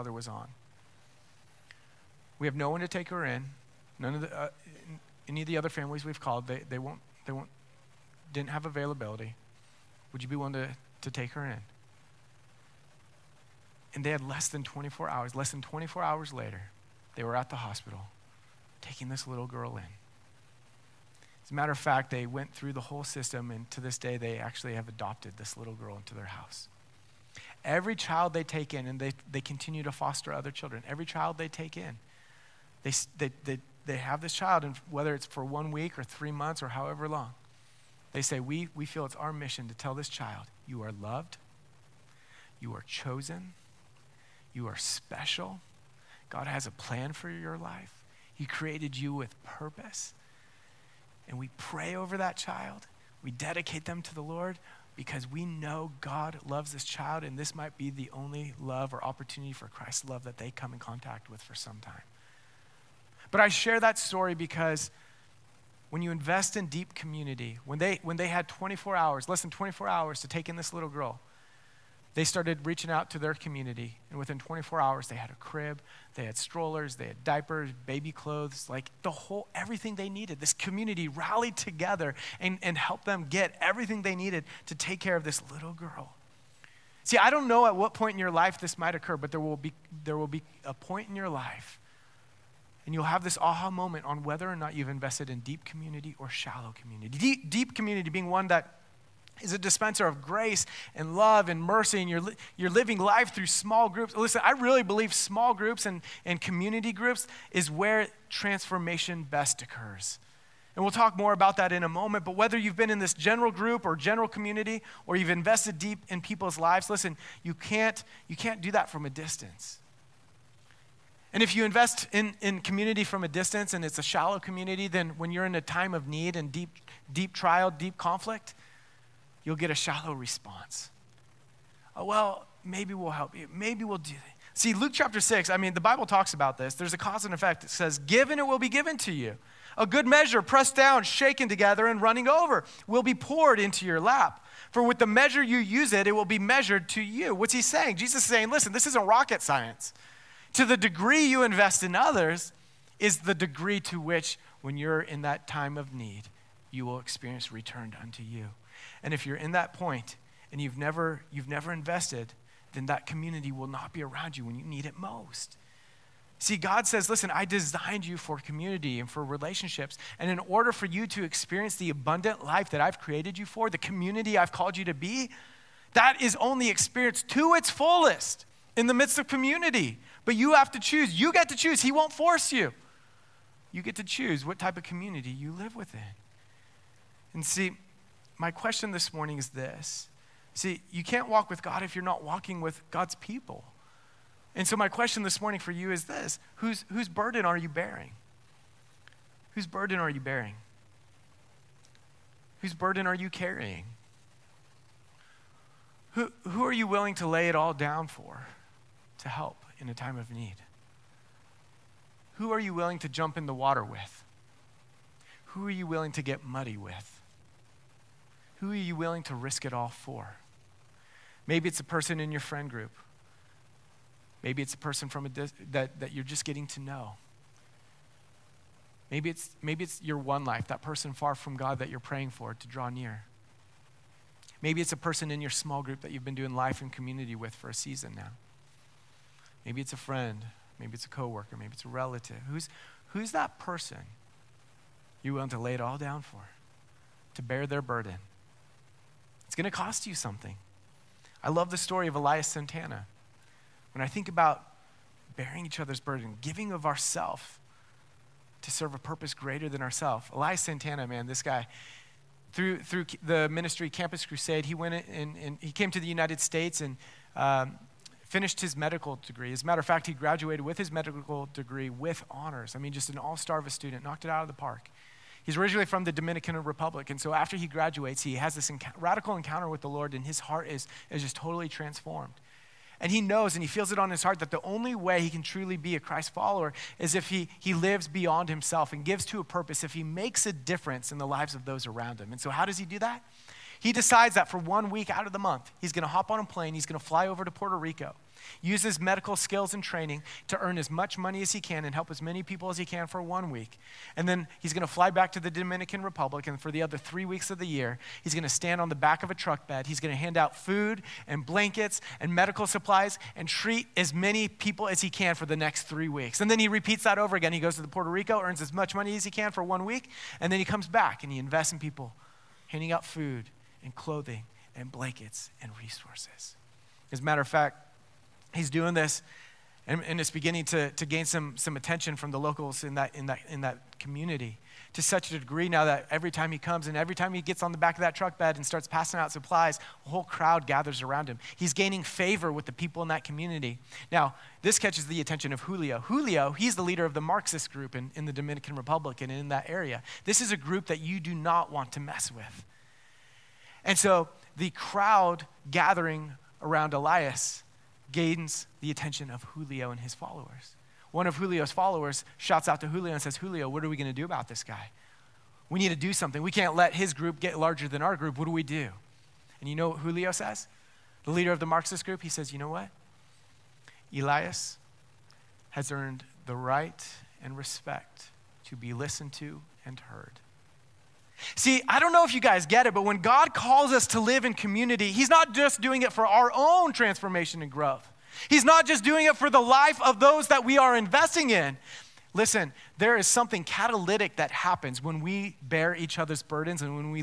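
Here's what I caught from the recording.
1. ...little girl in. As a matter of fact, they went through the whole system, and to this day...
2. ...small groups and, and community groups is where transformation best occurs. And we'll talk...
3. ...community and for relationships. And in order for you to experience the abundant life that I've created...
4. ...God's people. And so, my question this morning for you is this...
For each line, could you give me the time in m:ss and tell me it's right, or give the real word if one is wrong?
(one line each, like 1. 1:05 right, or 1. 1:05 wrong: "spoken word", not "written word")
1. 0:19 right
2. 1:45 right
3. 2:48 right
4. 3:12 right.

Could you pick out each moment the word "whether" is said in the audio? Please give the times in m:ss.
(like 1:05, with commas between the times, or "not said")
0:34, 1:34, 1:52.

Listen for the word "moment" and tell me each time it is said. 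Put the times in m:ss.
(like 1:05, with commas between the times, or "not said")
1:33, 1:51.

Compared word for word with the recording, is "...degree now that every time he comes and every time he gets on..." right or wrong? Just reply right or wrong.
right.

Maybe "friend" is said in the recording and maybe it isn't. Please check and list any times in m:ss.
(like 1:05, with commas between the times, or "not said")
3:42, 3:59.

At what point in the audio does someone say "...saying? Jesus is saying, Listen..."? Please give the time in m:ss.
2:27.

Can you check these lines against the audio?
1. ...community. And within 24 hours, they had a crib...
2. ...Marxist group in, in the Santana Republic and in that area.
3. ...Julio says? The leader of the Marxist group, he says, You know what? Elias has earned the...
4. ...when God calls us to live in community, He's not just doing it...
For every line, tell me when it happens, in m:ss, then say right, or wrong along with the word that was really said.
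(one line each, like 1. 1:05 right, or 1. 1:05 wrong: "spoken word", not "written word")
1. 1:13 right
2. 5:47 wrong: "Dominican", not "Santana"
3. 6:09 right
4. 6:23 right.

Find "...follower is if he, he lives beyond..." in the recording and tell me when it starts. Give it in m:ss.
4:46.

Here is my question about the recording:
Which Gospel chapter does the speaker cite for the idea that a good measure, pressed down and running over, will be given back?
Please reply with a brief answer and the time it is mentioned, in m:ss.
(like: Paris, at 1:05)
Luke chapter 6, at 2:14.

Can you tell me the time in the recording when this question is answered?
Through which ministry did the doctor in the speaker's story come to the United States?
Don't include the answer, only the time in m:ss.
4:23.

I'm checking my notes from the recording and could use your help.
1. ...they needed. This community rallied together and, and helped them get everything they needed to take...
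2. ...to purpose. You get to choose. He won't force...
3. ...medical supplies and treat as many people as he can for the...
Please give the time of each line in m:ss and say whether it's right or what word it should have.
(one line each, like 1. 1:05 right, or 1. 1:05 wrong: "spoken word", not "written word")
1. 1:19 right
2. 3:00 wrong: "choose", not "purpose"
3. 5:12 right.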